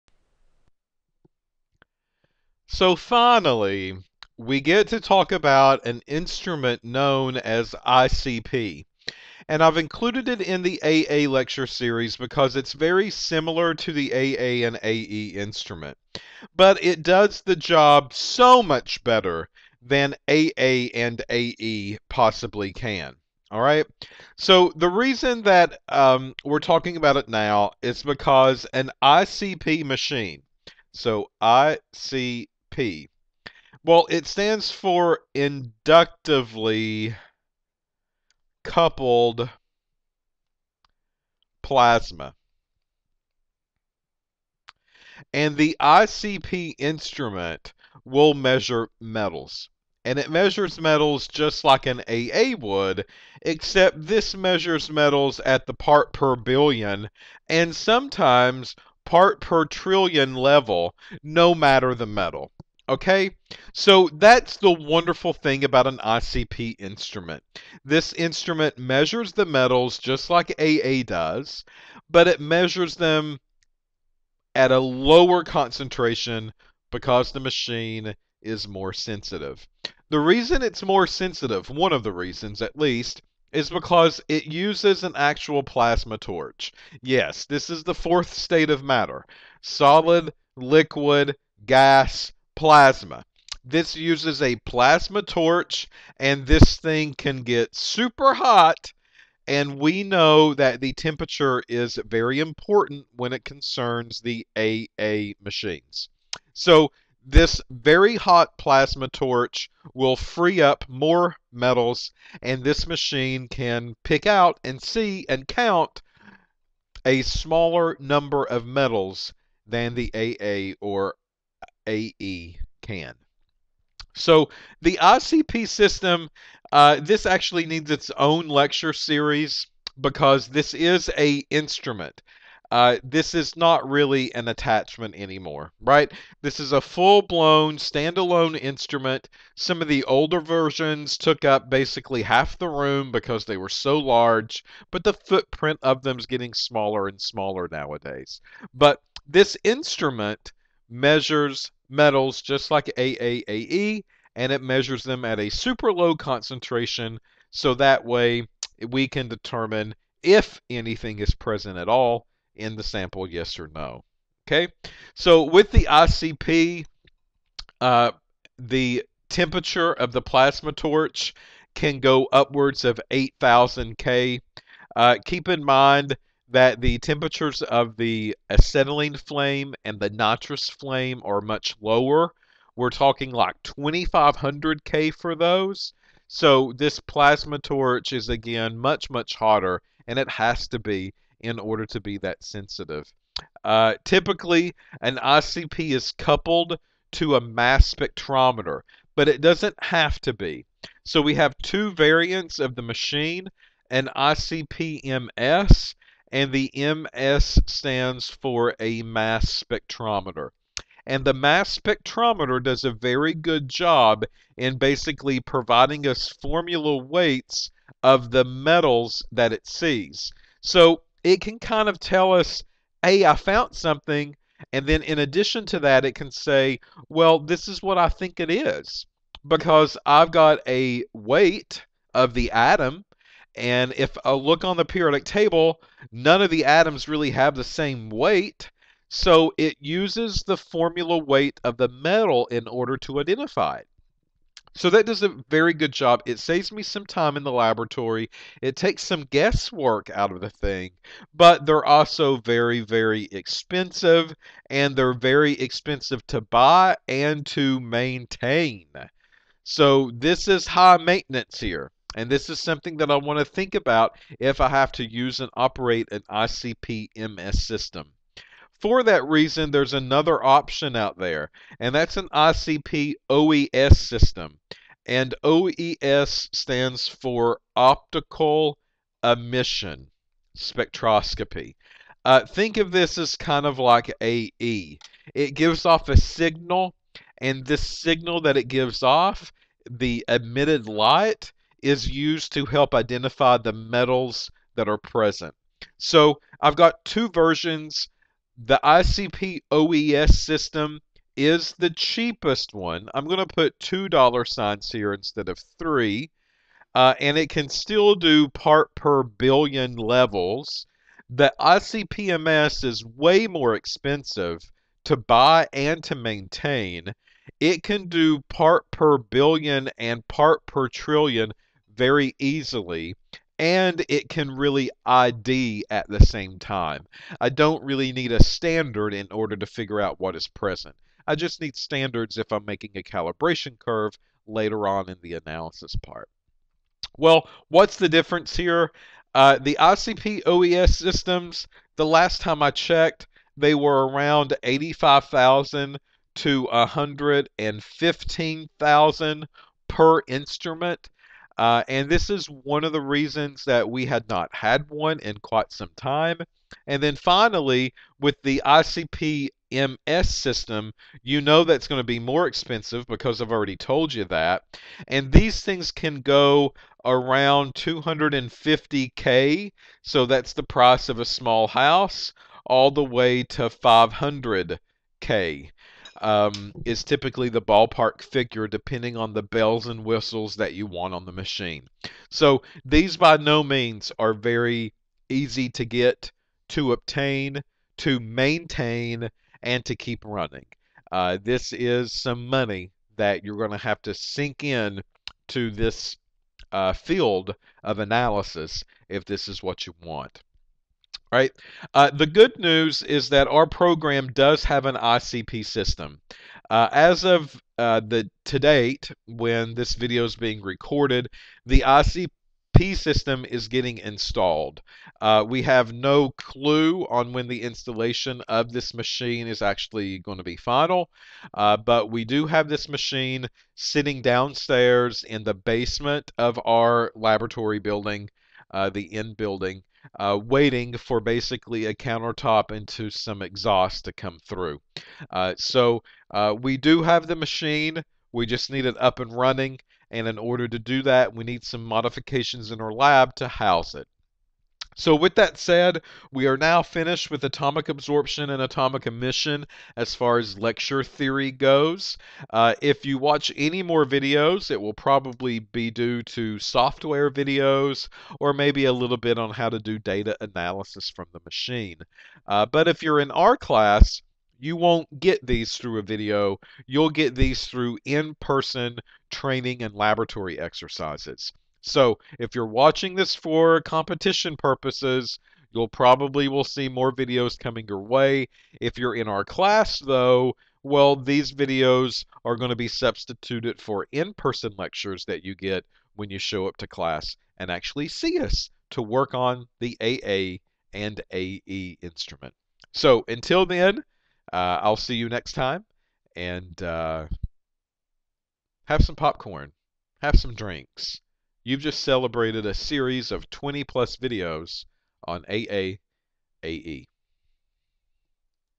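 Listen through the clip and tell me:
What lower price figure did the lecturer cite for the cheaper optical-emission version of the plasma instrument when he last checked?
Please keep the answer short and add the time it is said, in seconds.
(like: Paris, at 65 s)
85,000, at 344 s.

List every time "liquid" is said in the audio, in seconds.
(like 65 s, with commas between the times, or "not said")
90 s.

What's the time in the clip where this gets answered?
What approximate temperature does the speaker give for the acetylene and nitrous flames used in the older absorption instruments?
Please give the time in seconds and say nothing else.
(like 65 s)
183 s.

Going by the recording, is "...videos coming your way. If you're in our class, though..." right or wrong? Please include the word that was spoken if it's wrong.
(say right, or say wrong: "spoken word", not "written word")
right.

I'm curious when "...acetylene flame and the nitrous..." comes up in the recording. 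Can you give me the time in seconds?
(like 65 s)
178 s.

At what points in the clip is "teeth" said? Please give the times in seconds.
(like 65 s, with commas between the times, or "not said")
not said.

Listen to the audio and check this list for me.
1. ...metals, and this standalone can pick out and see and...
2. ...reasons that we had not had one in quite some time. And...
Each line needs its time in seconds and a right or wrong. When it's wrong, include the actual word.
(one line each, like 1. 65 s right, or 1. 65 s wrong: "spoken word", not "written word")
1. 111 s wrong: "machine", not "standalone"
2. 352 s right.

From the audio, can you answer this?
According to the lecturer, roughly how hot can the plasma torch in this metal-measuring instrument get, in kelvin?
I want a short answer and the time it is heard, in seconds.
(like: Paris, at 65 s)
8,000 K, at 173 s.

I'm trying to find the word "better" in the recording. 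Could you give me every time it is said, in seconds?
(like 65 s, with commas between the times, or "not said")
19 s.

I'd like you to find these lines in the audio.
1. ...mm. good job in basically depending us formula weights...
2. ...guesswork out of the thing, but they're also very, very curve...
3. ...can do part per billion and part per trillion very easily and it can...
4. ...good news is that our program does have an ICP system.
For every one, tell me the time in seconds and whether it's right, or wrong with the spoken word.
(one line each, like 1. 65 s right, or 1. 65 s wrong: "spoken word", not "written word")
1. 213 s wrong: "providing", not "depending"
2. 249 s wrong: "expensive", not "curve"
3. 317 s right
4. 402 s right.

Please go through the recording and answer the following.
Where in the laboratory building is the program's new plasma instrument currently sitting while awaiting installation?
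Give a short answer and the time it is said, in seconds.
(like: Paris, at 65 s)
the basement, at 425 s.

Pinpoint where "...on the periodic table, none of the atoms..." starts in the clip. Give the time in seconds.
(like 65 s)
234 s.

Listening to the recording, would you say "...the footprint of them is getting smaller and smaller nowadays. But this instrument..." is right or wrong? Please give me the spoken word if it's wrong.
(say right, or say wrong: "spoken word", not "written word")
right.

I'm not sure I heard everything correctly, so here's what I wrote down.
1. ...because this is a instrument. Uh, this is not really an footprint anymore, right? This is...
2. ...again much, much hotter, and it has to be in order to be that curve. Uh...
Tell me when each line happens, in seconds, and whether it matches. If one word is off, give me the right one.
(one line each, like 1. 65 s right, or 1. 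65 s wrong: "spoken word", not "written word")
1. 129 s wrong: "attachment", not "footprint"
2. 188 s wrong: "sensitive", not "curve".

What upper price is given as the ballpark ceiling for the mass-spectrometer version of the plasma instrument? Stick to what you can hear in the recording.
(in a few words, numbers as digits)
500K.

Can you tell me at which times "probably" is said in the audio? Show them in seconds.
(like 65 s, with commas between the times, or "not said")
454 s, 475 s.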